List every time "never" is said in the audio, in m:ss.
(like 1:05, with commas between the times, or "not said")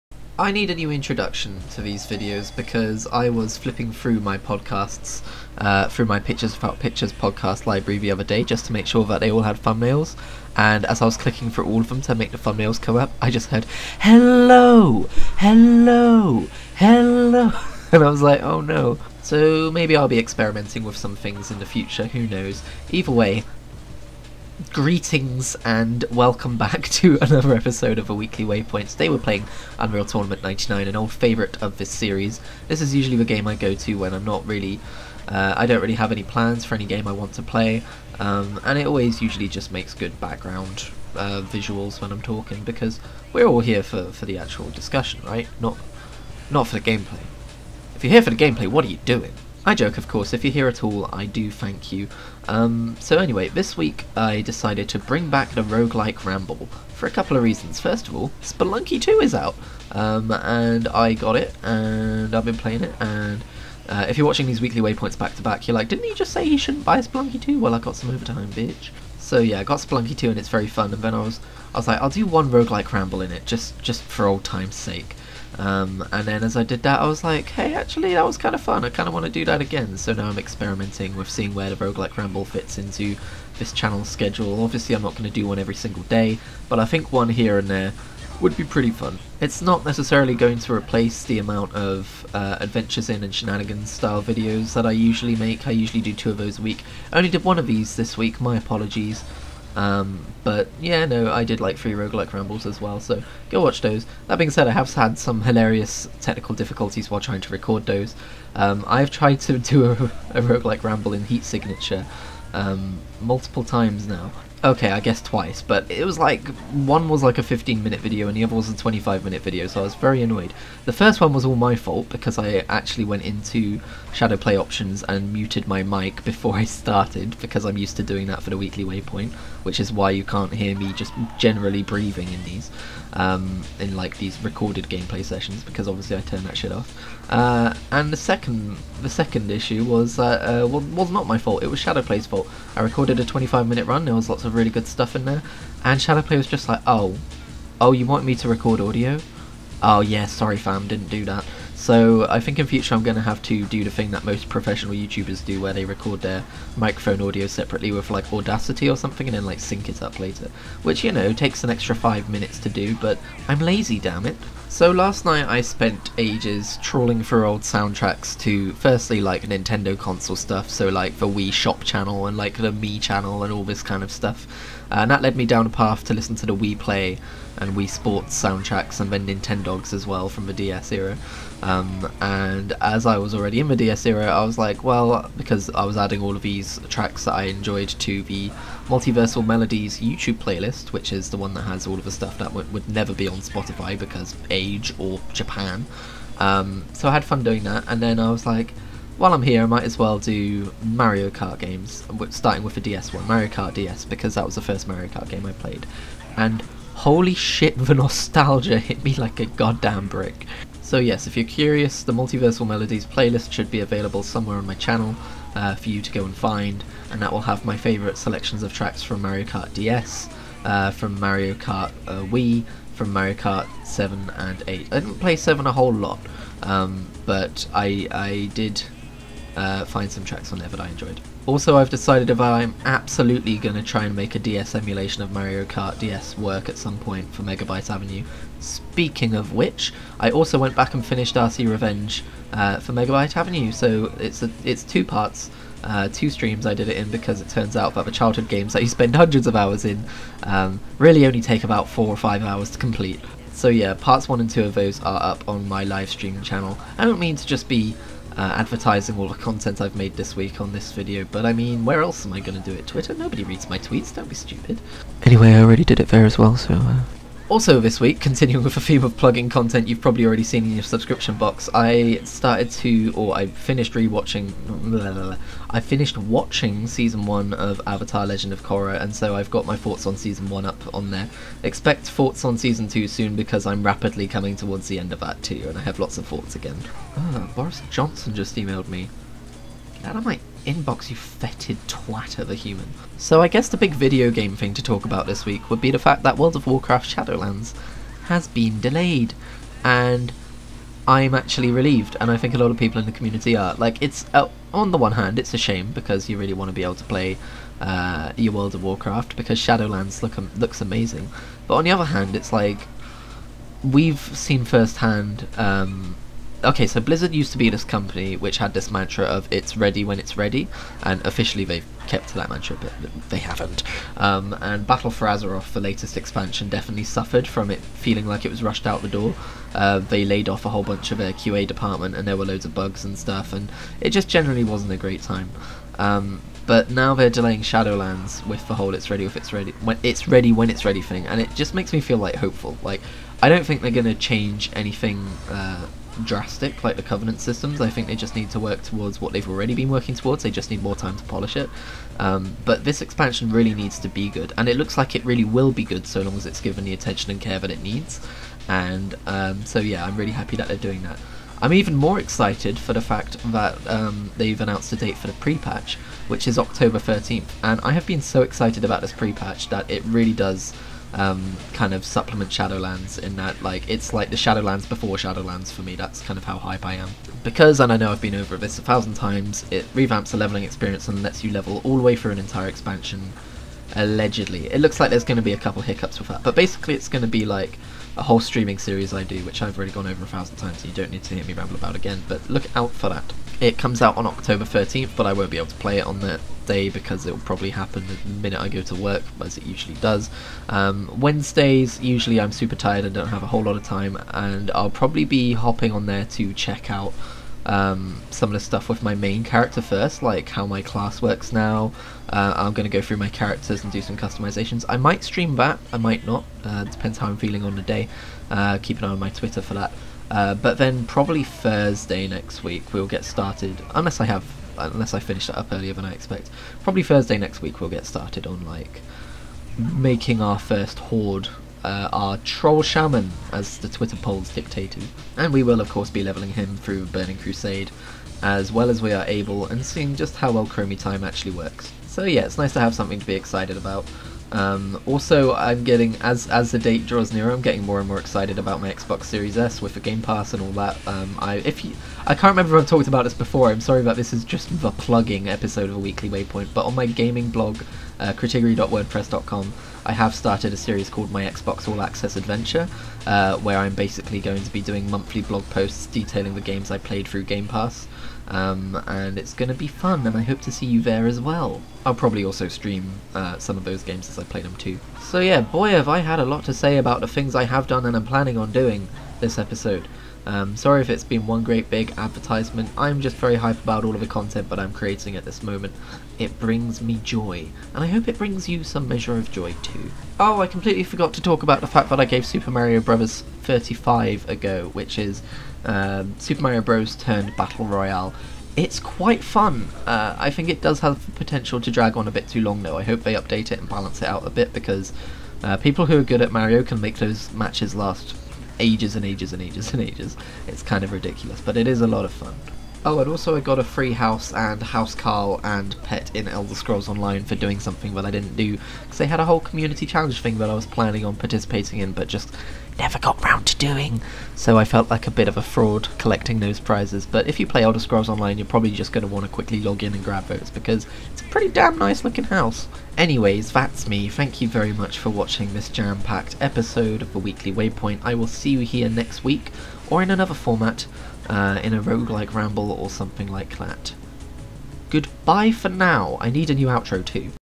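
3:12, 8:42.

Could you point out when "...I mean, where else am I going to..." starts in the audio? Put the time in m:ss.
4:21.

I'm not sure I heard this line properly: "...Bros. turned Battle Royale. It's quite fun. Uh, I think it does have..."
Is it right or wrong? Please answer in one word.
right.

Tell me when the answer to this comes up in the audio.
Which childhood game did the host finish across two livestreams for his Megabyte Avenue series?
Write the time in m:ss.
4:01.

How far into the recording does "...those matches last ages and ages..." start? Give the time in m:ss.
8:27.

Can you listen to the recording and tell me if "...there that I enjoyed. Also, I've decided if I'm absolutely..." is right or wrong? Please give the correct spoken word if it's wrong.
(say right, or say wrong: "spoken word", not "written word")
right.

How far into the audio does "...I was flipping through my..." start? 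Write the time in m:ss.
0:03.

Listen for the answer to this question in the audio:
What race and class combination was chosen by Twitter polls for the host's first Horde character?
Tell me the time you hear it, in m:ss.
7:12.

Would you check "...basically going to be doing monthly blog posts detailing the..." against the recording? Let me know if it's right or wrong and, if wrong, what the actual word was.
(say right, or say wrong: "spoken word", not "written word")
right.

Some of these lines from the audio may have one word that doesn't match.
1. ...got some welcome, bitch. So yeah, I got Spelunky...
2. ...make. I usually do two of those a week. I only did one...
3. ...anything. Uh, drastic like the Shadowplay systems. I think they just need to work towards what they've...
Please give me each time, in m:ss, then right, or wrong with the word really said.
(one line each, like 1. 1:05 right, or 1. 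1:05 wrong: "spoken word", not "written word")
1. 1:07 wrong: "overtime", not "welcome"
2. 1:35 right
3. 5:44 wrong: "Covenant", not "Shadowplay".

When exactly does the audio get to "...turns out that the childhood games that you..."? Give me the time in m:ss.
4:07.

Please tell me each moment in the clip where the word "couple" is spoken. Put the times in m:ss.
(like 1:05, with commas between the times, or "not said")
0:57, 6:25.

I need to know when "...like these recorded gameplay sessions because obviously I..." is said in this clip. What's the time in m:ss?
2:13.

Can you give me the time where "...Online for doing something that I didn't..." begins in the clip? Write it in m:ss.
8:37.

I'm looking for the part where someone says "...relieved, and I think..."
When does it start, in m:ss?
5:01.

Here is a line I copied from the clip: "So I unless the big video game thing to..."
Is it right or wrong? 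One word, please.
wrong.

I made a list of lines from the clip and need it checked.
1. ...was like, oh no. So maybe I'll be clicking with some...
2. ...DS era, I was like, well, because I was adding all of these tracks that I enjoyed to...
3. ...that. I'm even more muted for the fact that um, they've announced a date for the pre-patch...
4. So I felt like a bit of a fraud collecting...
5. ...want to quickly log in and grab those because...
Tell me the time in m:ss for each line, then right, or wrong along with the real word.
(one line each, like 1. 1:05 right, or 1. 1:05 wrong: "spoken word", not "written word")
1. 0:18 wrong: "experimenting", not "clicking"
2. 3:03 right
3. 6:01 wrong: "excited", not "muted"
4. 8:44 right
5. 8:49 right.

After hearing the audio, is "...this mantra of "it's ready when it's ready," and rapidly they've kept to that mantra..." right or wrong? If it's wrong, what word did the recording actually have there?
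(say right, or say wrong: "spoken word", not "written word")
wrong: "officially", not "rapidly".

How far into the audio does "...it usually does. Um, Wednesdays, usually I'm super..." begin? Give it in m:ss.
6:39.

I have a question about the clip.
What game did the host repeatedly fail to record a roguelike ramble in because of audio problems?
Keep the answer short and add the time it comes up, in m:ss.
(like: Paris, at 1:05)
Heat Signature, at 1:51.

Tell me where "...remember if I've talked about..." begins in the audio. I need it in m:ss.
7:32.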